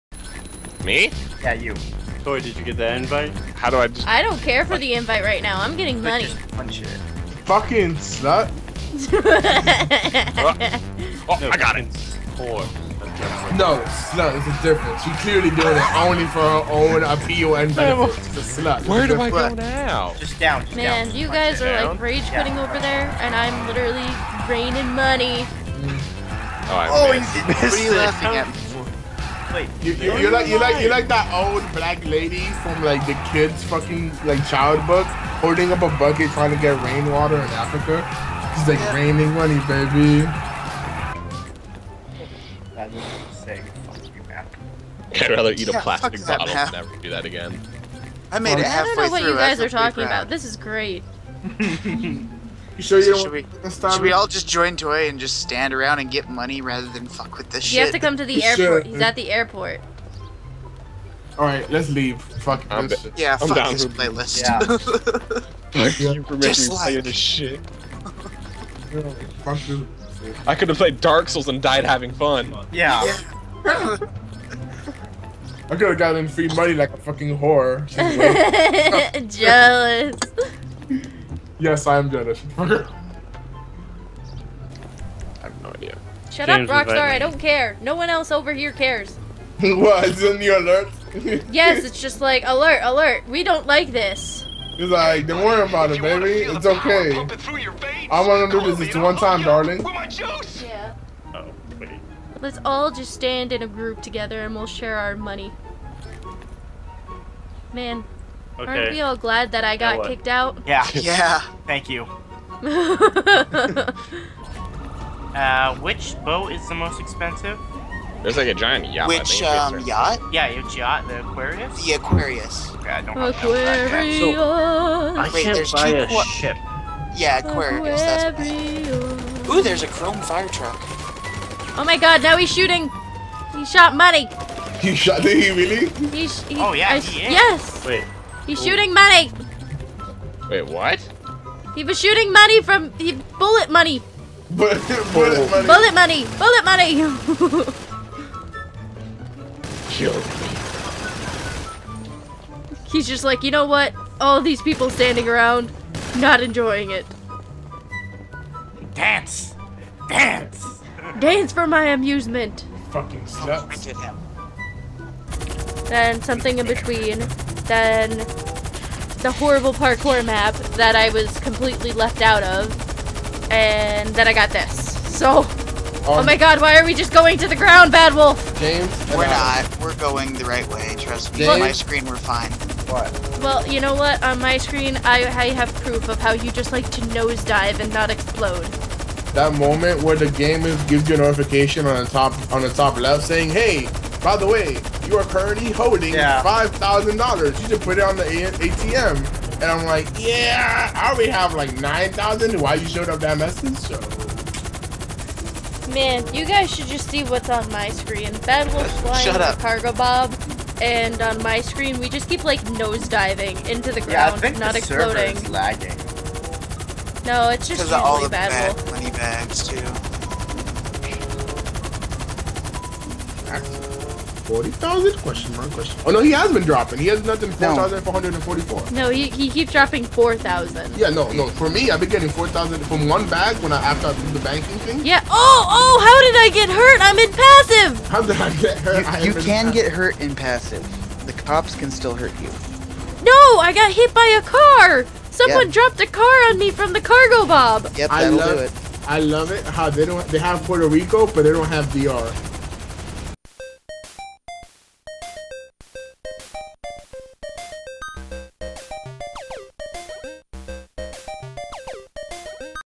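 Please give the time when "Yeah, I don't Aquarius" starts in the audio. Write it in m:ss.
2:02.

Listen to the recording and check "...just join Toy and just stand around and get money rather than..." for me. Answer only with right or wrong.
right.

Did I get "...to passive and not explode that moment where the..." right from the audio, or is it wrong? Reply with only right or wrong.
wrong.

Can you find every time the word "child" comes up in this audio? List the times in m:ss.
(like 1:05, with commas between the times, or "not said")
0:34.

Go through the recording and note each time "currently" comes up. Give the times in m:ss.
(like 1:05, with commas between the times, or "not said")
3:15.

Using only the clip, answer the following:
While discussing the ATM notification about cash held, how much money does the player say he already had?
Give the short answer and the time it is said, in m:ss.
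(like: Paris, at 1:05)
9,000, at 3:21.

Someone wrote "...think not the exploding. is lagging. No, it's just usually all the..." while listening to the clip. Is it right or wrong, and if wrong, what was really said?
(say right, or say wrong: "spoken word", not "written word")
right.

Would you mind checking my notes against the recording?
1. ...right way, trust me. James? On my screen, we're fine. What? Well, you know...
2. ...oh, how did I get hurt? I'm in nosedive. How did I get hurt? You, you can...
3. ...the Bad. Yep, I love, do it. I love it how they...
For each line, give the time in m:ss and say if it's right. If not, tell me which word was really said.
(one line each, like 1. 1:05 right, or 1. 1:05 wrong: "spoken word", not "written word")
1. 3:00 right
2. 3:55 wrong: "passive", not "nosedive"
3. 4:06 wrong: "Cargobob", not "Bad".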